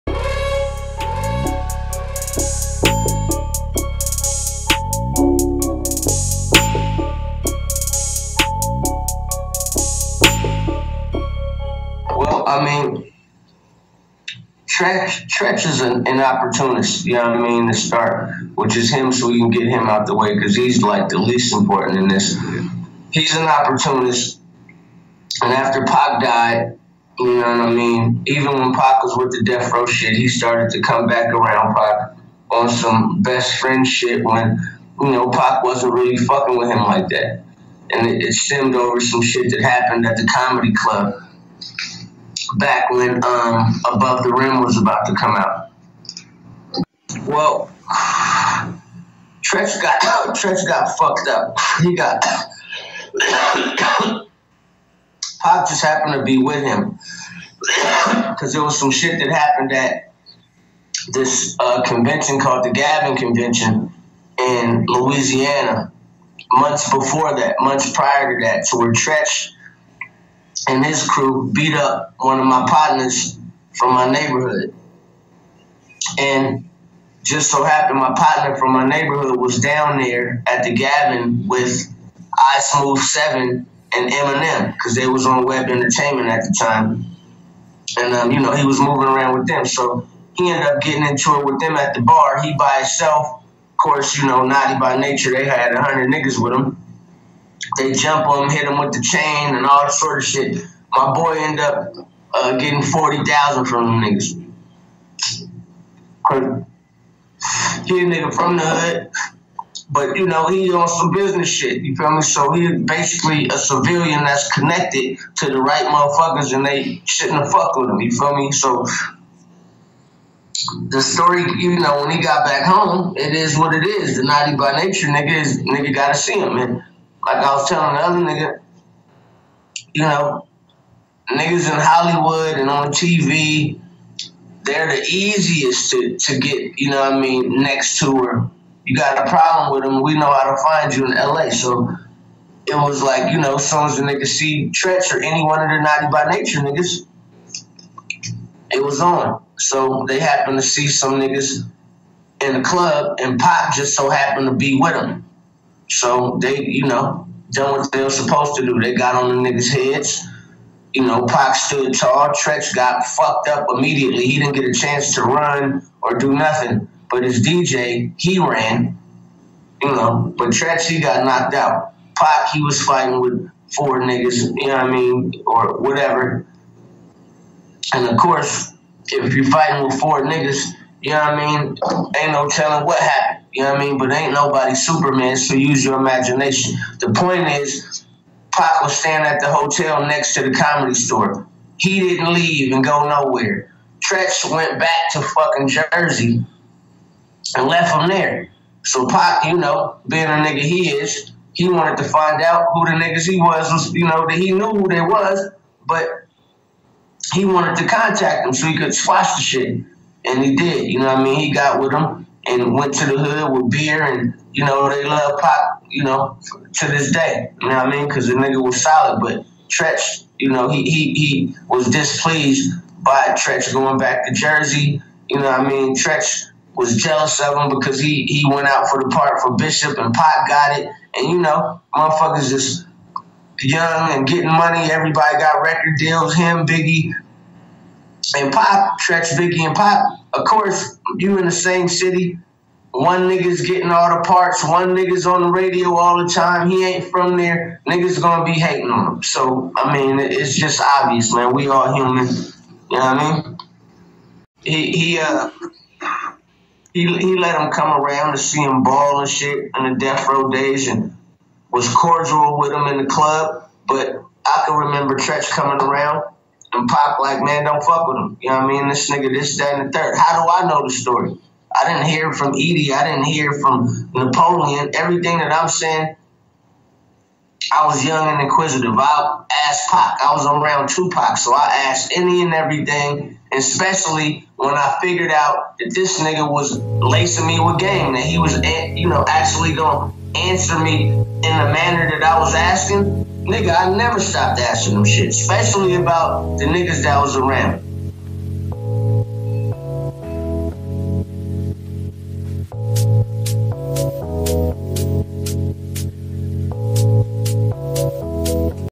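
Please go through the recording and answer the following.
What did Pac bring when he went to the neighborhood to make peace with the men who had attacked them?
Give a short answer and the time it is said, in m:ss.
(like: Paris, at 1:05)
beer, at 3:33.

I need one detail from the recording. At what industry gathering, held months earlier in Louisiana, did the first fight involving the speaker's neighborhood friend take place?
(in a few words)
Gavin Convention.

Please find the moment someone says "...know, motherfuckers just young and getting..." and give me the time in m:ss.
3:51.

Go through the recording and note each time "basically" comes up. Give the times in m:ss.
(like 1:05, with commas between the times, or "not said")
1:52.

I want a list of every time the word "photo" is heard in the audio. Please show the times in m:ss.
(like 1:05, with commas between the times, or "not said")
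not said.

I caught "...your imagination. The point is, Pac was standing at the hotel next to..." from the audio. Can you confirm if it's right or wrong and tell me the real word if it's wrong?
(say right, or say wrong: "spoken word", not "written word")
right.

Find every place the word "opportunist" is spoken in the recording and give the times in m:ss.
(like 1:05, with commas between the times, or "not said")
0:16, 0:23.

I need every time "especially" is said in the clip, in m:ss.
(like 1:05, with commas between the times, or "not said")
4:43, 4:55.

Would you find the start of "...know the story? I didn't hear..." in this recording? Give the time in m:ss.
4:30.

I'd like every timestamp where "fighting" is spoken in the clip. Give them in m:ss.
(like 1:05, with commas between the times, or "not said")
2:52, 2:59.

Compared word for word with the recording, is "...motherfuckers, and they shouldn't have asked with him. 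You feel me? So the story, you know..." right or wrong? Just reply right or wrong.
wrong.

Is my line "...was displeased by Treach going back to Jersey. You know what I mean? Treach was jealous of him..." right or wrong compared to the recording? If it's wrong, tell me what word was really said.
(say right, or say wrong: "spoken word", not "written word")
right.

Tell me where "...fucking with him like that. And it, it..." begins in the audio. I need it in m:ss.
0:36.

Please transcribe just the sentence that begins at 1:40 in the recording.
My boy end up uh, getting forty thousand from them niggas.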